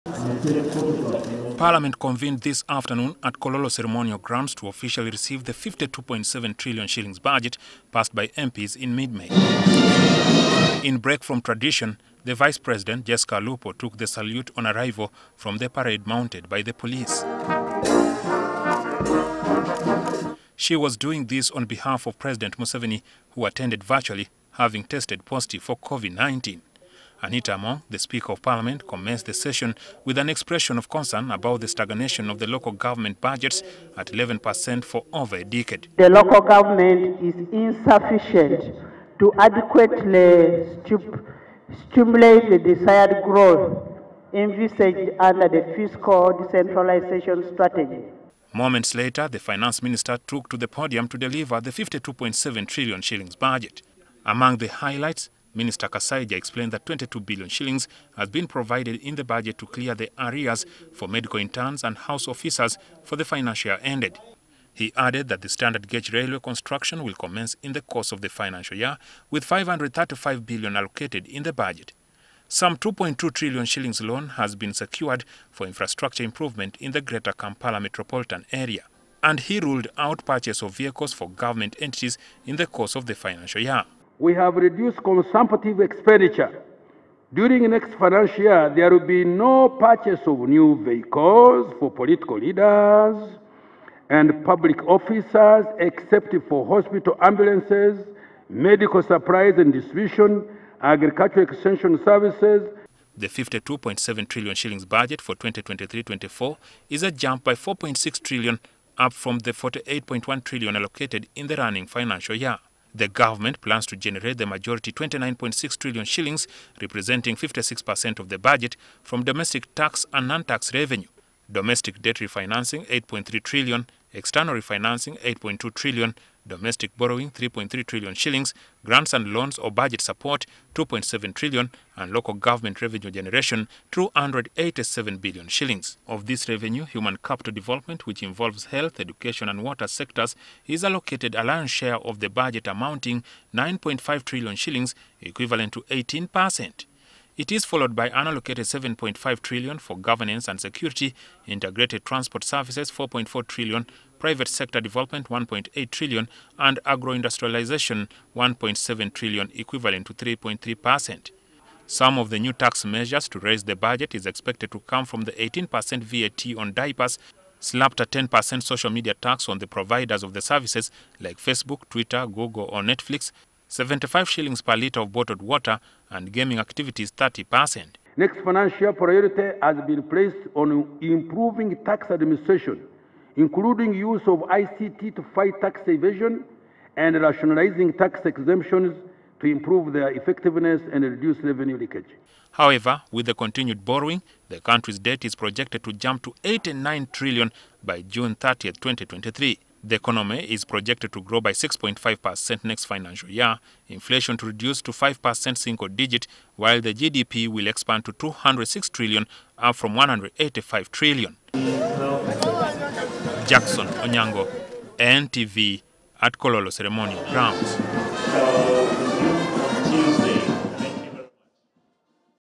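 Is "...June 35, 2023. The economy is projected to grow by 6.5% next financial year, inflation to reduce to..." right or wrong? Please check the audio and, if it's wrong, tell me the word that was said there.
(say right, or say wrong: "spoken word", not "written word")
wrong: "30", not "35".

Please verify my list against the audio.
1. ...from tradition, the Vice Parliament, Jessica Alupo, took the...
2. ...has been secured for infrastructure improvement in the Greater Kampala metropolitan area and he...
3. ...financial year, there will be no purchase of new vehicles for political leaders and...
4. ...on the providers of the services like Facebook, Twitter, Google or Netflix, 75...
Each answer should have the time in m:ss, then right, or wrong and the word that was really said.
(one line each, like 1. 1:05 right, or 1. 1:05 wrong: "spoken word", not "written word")
1. 0:11 wrong: "President", not "Parliament"
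2. 1:14 right
3. 1:28 right
4. 2:49 right.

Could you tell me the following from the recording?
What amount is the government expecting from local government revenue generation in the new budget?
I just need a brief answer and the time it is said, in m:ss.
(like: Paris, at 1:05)
287 billion shillings, at 2:13.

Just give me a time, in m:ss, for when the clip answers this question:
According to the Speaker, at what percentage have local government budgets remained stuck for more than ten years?
0:34.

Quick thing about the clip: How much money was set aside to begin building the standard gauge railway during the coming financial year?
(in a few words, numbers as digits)
535 billion.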